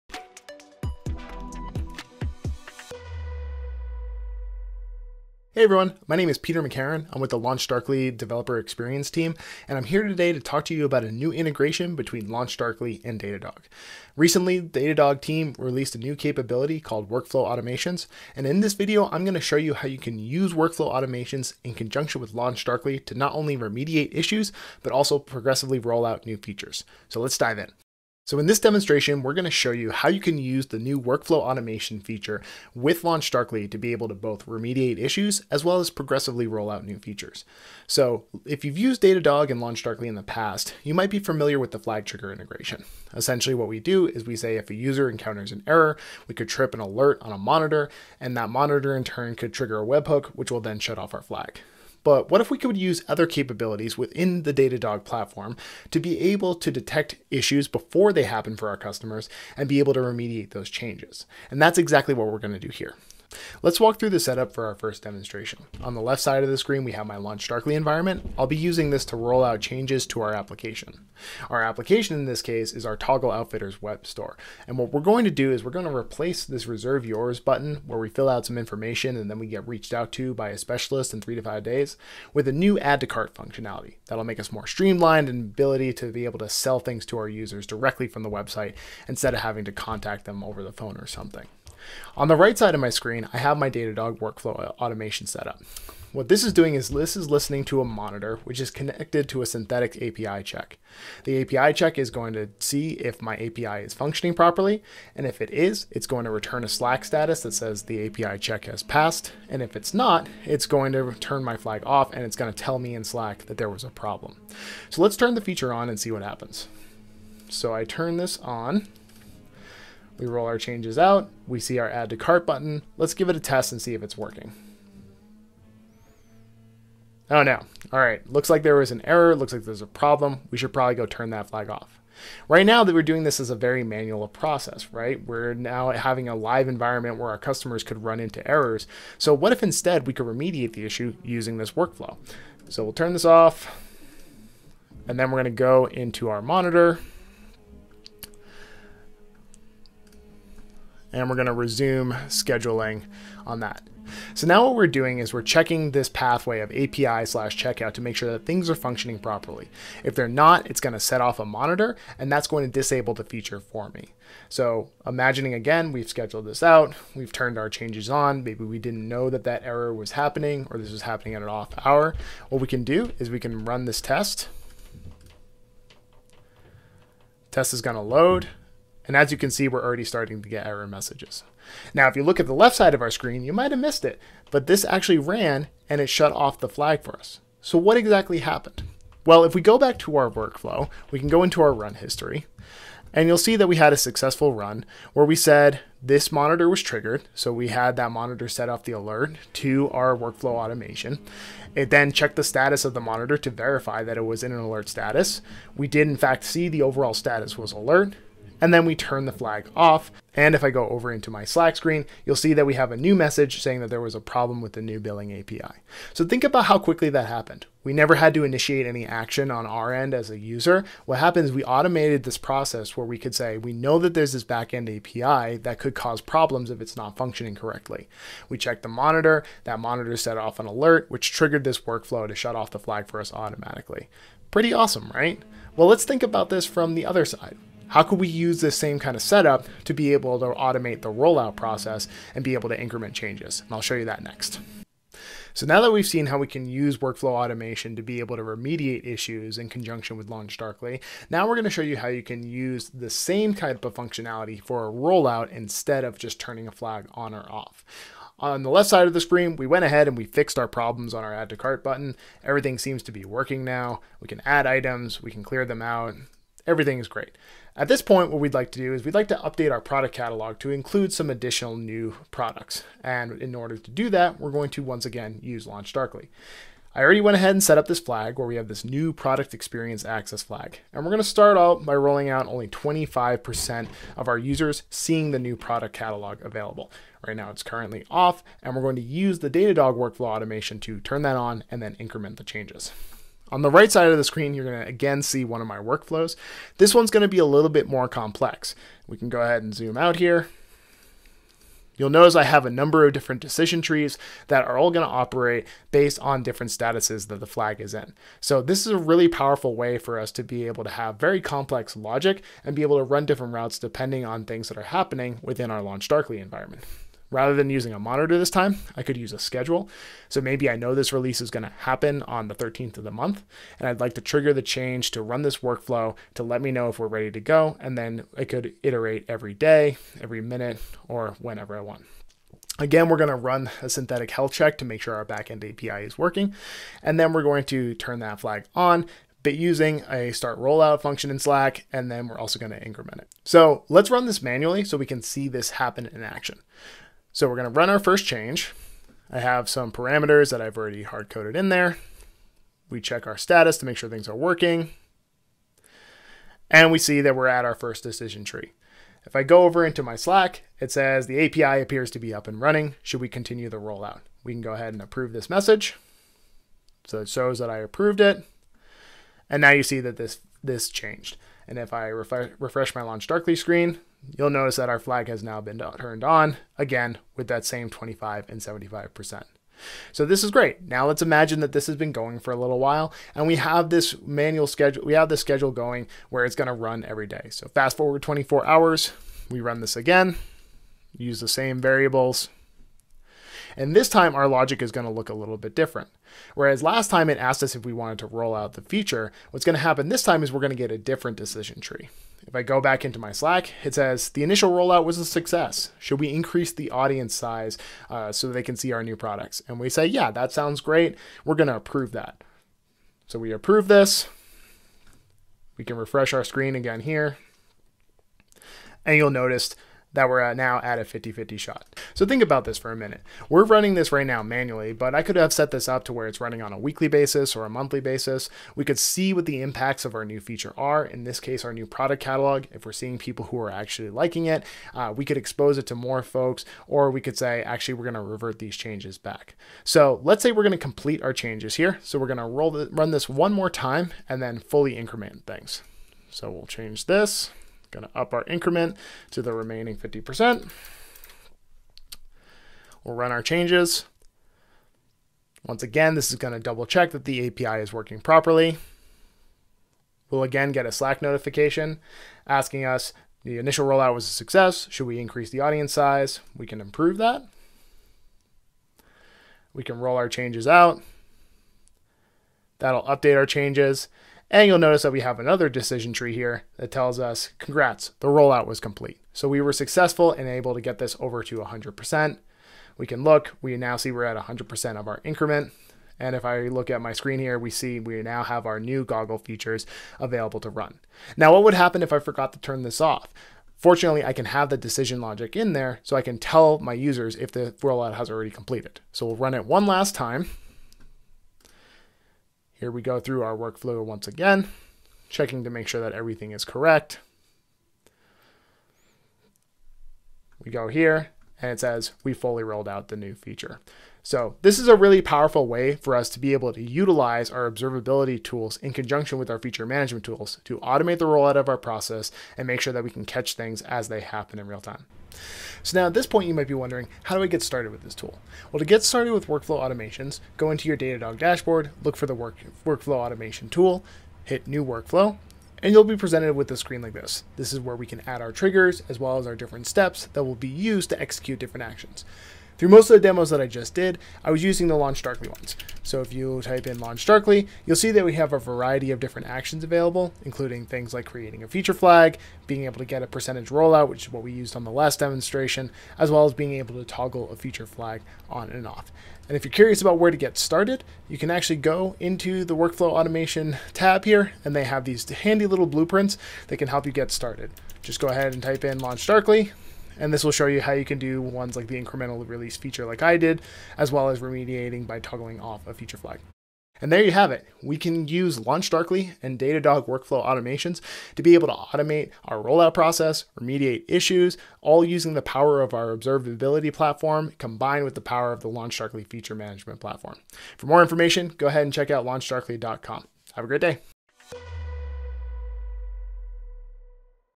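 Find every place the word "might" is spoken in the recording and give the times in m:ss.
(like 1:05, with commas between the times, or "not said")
0:40, 3:03, 8:46.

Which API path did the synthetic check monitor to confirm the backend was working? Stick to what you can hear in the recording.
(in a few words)
/checkout.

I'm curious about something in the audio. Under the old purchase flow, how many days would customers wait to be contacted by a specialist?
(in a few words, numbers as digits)
3 to 5 days.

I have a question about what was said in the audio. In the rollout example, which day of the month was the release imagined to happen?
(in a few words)
13th.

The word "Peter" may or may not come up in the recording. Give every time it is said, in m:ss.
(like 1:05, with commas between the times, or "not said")
0:06.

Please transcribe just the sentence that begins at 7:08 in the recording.
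We could see what the impacts of our new feature are, in this case, our new product catalog.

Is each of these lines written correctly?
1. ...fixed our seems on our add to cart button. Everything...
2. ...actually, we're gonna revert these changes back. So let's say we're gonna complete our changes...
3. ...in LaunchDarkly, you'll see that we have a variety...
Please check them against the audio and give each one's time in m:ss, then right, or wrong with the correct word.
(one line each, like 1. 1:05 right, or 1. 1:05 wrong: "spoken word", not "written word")
1. 4:20 wrong: "problems", not "seems"
2. 7:17 right
3. 9:06 right.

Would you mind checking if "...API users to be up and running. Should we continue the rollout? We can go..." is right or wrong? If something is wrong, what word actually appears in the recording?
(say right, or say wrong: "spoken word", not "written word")
wrong: "appears", not "users".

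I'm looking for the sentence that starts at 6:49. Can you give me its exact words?
And we say, yeah, that sounds great.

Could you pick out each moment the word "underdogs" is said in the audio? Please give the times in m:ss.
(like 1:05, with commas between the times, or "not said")
not said.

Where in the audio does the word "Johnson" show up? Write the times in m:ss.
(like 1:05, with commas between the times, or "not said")
not said.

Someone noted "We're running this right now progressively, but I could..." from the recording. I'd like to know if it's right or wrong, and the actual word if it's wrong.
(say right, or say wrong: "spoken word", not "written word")
wrong: "manually", not "progressively".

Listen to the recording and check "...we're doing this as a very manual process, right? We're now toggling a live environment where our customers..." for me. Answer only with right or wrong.
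wrong.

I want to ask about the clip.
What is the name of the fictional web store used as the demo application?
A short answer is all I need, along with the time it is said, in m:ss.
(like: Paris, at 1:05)
Toggle Outfitters, at 1:12.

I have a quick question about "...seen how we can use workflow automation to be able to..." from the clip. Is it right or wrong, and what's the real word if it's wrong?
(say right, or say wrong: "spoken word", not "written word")
right.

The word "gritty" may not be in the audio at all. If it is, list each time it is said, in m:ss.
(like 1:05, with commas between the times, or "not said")
not said.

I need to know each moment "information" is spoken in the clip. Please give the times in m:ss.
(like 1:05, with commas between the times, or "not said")
1:18, 9:51.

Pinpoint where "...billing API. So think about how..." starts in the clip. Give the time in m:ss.
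3:34.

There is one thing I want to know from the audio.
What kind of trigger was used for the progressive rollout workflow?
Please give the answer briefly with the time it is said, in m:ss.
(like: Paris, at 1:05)
A schedule, at 5:19.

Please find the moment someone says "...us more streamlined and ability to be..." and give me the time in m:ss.
1:24.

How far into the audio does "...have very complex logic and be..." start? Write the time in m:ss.
5:10.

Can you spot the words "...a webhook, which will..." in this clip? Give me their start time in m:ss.
0:49.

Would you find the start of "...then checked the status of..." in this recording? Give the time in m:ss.
3:21.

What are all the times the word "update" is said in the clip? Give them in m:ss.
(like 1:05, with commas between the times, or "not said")
4:29, 7:53.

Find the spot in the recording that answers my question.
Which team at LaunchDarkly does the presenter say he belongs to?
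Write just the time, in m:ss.
0:08.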